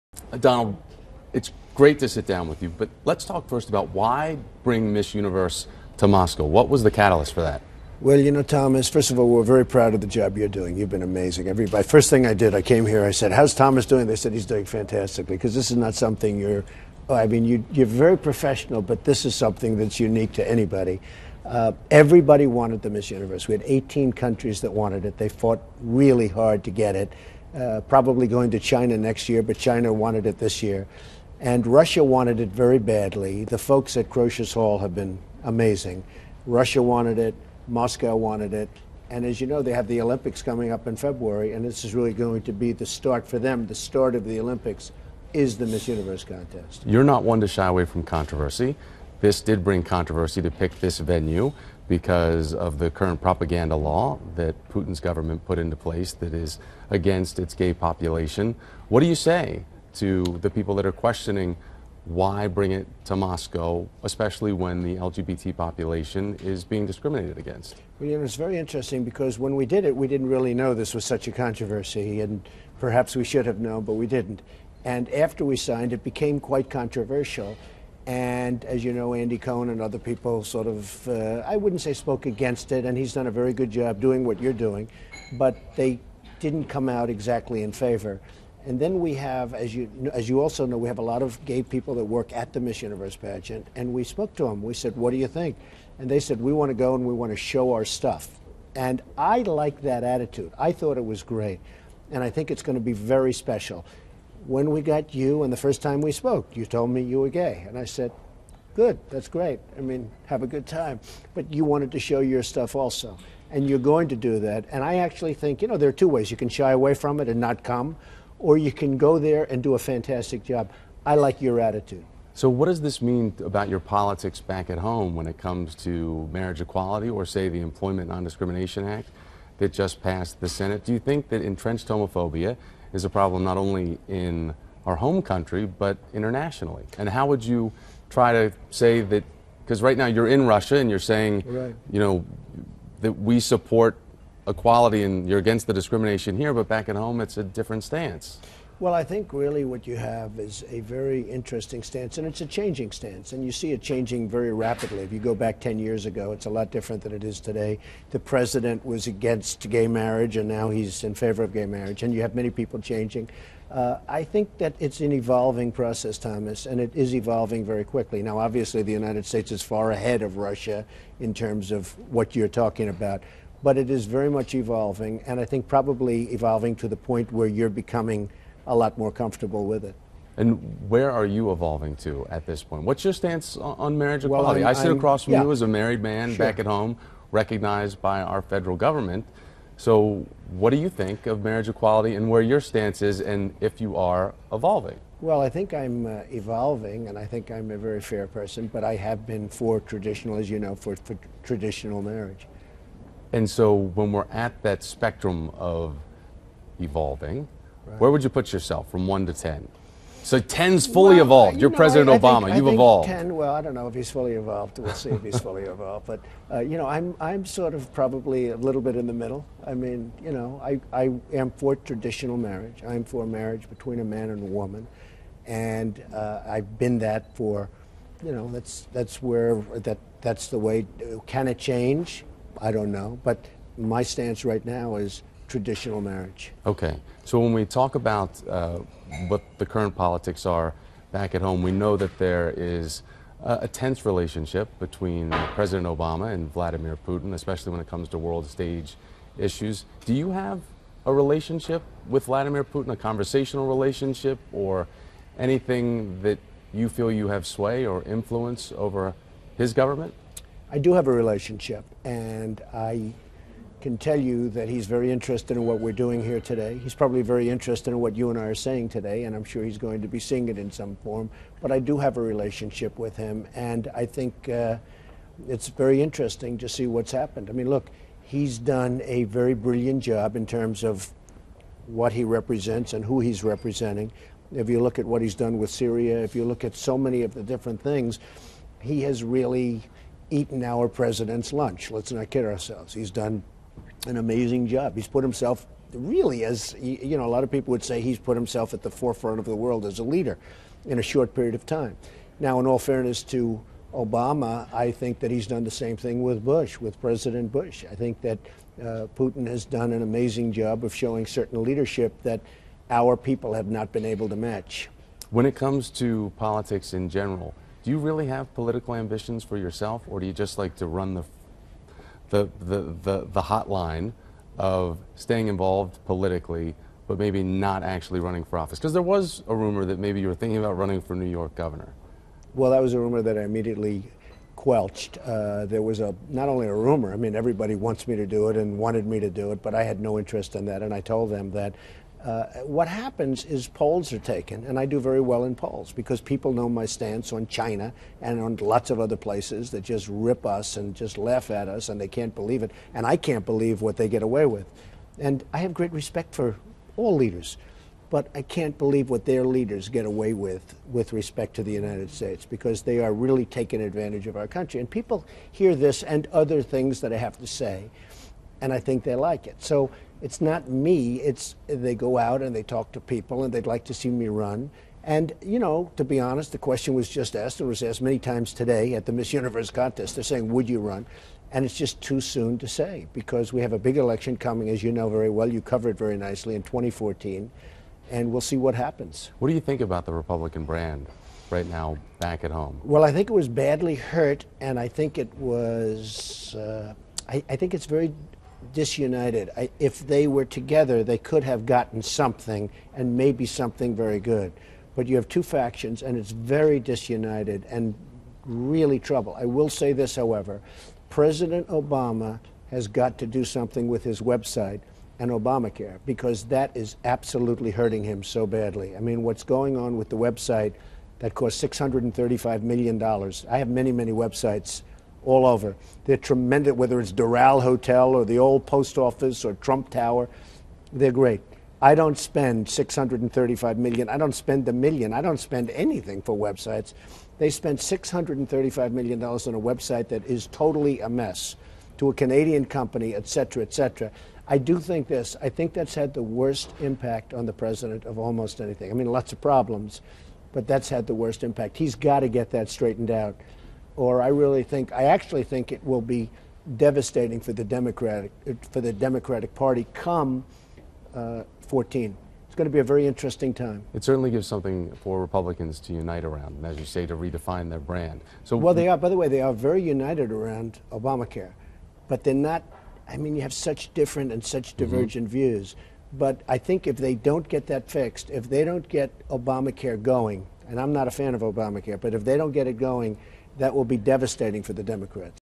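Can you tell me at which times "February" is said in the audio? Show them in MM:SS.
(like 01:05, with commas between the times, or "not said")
00:40.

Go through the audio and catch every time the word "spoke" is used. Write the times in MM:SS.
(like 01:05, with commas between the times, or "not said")
01:21, 01:34, 01:46.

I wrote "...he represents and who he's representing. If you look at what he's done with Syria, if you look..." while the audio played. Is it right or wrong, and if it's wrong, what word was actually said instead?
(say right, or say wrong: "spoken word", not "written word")
right.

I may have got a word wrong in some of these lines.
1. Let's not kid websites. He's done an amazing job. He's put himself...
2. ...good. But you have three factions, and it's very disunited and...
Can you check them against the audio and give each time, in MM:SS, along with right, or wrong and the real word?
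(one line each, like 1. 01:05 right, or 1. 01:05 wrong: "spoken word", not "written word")
1. 04:51 wrong: "ourselves", not "websites"
2. 06:44 wrong: "two", not "three".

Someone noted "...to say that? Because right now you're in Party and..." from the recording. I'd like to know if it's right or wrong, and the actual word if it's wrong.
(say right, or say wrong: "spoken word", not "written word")
wrong: "Russia", not "Party".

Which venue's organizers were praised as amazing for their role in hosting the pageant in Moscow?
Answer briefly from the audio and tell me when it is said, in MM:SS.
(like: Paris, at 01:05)
Crocus Hall, at 00:34.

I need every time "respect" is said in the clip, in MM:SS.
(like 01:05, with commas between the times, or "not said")
05:55, 06:01.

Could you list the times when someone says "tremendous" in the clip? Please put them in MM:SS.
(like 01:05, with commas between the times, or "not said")
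07:06.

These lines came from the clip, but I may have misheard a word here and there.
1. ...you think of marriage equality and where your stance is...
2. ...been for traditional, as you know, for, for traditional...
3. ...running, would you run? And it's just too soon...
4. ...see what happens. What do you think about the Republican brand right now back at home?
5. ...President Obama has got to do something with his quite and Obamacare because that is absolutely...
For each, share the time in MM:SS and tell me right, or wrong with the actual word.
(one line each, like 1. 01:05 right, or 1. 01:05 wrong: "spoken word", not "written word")
1. 03:10 right
2. 03:19 right
3. 06:20 wrong: "saying", not "running"
4. 06:28 right
5. 06:51 wrong: "website", not "quite".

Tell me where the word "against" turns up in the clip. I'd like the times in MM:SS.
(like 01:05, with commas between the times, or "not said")
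00:56, 01:07, 01:22, 02:25, 02:39.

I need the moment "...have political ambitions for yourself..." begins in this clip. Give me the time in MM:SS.
05:18.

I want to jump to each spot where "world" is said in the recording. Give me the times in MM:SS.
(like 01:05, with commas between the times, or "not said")
04:08, 04:59.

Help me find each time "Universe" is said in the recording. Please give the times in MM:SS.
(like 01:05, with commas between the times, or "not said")
00:05, 00:23, 00:45, 01:32, 06:19.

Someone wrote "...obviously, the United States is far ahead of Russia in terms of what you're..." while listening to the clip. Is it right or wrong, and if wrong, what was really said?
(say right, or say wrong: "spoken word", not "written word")
right.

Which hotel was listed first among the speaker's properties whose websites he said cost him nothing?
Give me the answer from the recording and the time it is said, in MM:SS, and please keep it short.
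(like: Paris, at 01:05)
Doral Hotel, at 07:07.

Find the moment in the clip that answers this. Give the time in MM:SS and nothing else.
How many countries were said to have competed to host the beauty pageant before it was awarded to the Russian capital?
00:23.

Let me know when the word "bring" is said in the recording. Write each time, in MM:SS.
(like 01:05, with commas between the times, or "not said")
00:04, 00:49, 01:02.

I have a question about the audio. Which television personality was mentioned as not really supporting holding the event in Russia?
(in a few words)
Andy Cohen.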